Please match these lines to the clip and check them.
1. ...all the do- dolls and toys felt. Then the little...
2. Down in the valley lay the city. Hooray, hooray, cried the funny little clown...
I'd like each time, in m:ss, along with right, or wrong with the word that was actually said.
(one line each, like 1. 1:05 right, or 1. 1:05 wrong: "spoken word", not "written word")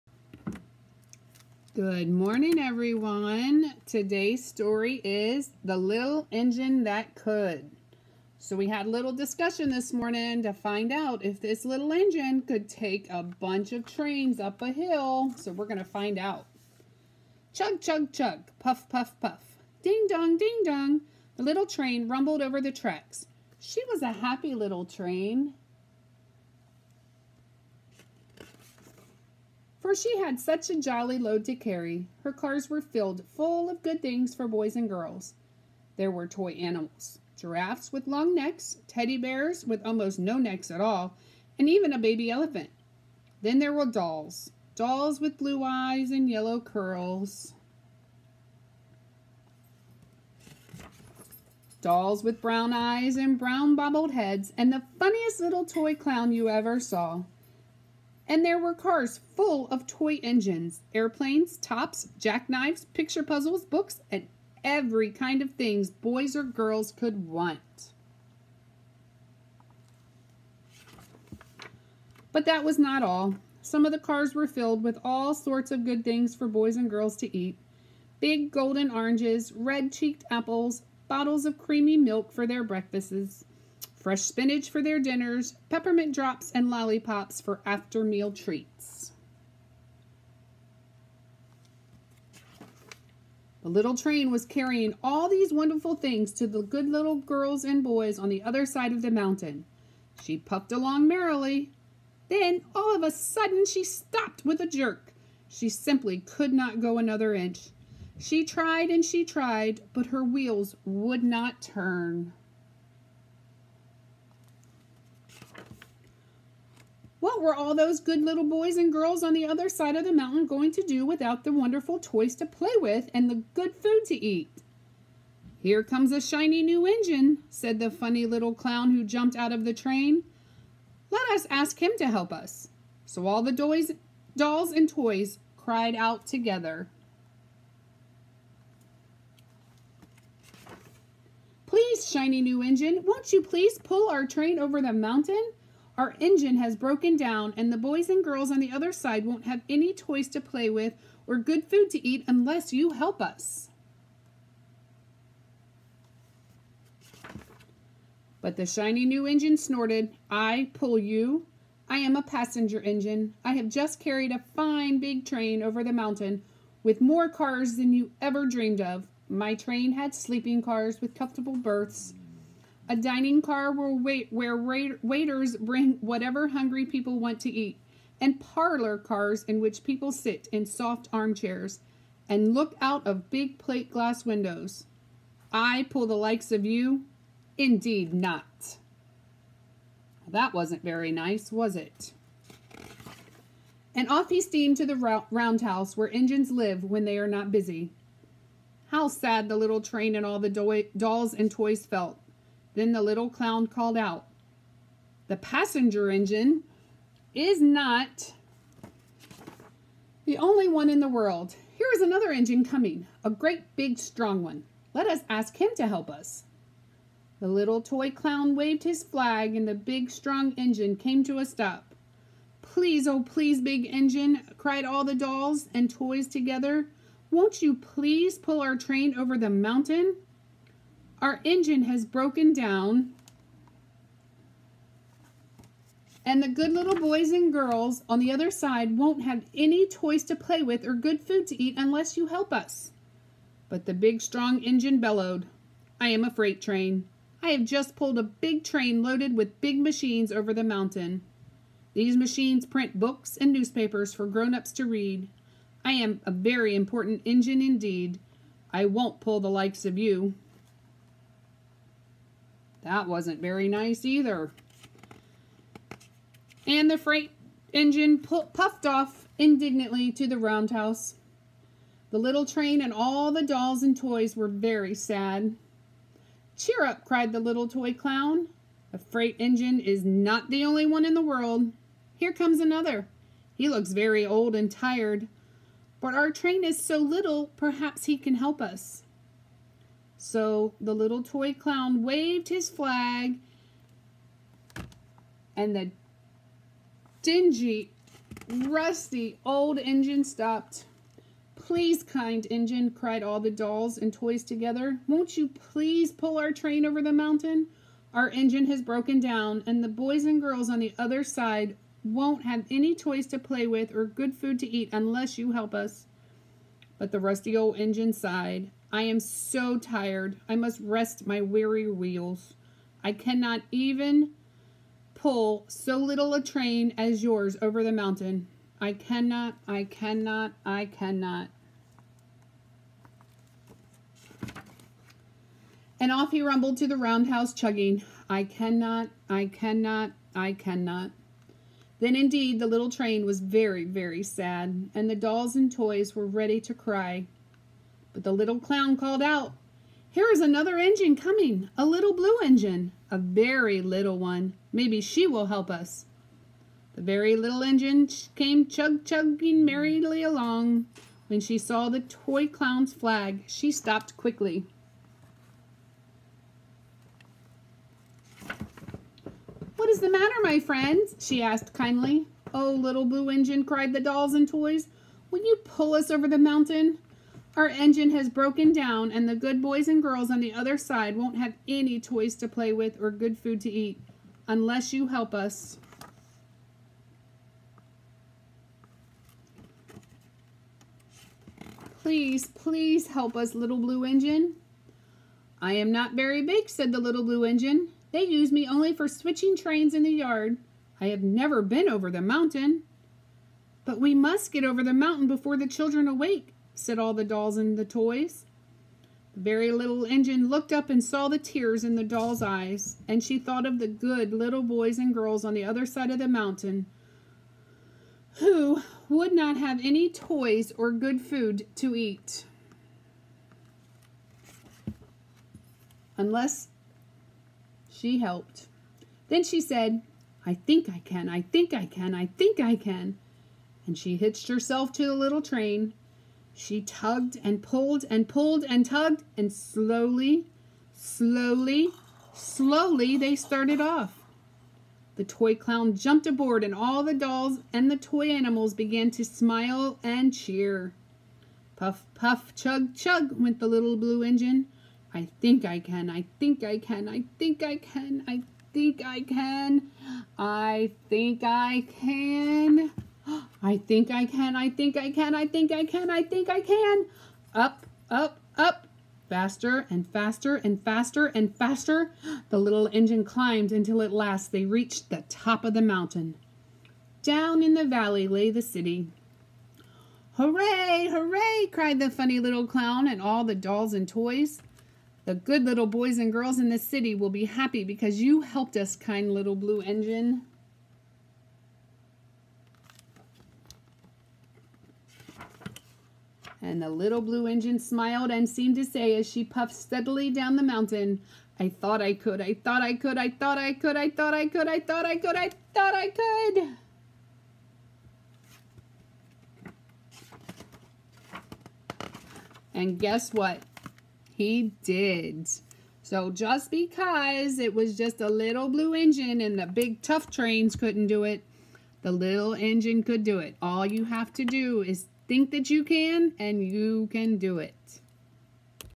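1. 3:20 right
2. 7:57 right.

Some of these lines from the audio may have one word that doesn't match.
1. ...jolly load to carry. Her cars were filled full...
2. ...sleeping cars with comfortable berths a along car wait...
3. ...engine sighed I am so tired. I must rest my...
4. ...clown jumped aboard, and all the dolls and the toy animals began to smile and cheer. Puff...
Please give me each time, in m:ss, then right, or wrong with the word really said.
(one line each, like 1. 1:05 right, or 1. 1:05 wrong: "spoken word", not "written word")
1. 0:30 right
2. 2:50 wrong: "dining", not "along"
3. 5:17 right
4. 7:25 right.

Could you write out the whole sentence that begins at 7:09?
Then she said, I think I can, I think I can, I think I can.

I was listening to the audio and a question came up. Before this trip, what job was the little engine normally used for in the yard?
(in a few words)
Switching trains.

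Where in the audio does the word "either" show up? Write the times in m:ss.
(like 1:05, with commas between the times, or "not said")
4:24.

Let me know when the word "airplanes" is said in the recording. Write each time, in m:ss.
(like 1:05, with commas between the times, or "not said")
1:00.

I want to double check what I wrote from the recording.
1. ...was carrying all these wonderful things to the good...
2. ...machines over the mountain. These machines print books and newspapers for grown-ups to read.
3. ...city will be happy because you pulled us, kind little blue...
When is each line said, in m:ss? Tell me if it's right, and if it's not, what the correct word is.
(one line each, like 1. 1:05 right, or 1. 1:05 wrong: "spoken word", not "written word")
1. 1:34 right
2. 4:09 right
3. 8:06 wrong: "helped", not "pulled".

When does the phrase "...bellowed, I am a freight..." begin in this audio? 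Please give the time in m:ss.
4:04.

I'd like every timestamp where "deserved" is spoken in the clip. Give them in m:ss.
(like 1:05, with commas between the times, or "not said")
not said.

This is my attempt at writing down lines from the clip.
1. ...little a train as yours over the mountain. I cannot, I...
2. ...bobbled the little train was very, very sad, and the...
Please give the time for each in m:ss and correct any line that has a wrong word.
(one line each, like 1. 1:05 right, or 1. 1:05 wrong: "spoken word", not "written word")
1. 5:25 right
2. 5:42 wrong: "indeed", not "bobbled".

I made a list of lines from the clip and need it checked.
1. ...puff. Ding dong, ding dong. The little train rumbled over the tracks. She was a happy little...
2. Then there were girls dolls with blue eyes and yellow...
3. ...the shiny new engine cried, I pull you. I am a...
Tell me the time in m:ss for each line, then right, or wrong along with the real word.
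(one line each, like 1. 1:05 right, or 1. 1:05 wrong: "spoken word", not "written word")
1. 0:19 right
2. 0:43 wrong: "dolls", not "girls"
3. 2:38 wrong: "snorted", not "cried".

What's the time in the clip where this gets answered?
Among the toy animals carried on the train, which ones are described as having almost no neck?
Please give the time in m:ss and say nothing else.
0:38.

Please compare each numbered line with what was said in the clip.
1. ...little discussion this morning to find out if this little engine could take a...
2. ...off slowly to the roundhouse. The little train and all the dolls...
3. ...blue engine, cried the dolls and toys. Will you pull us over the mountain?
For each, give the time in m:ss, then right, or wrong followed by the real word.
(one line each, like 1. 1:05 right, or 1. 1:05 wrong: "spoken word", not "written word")
1. 0:08 right
2. 4:28 wrong: "indignantly", not "slowly"
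3. 6:13 right.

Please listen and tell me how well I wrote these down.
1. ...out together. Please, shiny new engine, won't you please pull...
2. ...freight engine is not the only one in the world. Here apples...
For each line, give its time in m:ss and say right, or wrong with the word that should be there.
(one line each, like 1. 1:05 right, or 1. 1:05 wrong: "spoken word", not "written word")
1. 2:15 right
2. 4:38 wrong: "comes", not "apples".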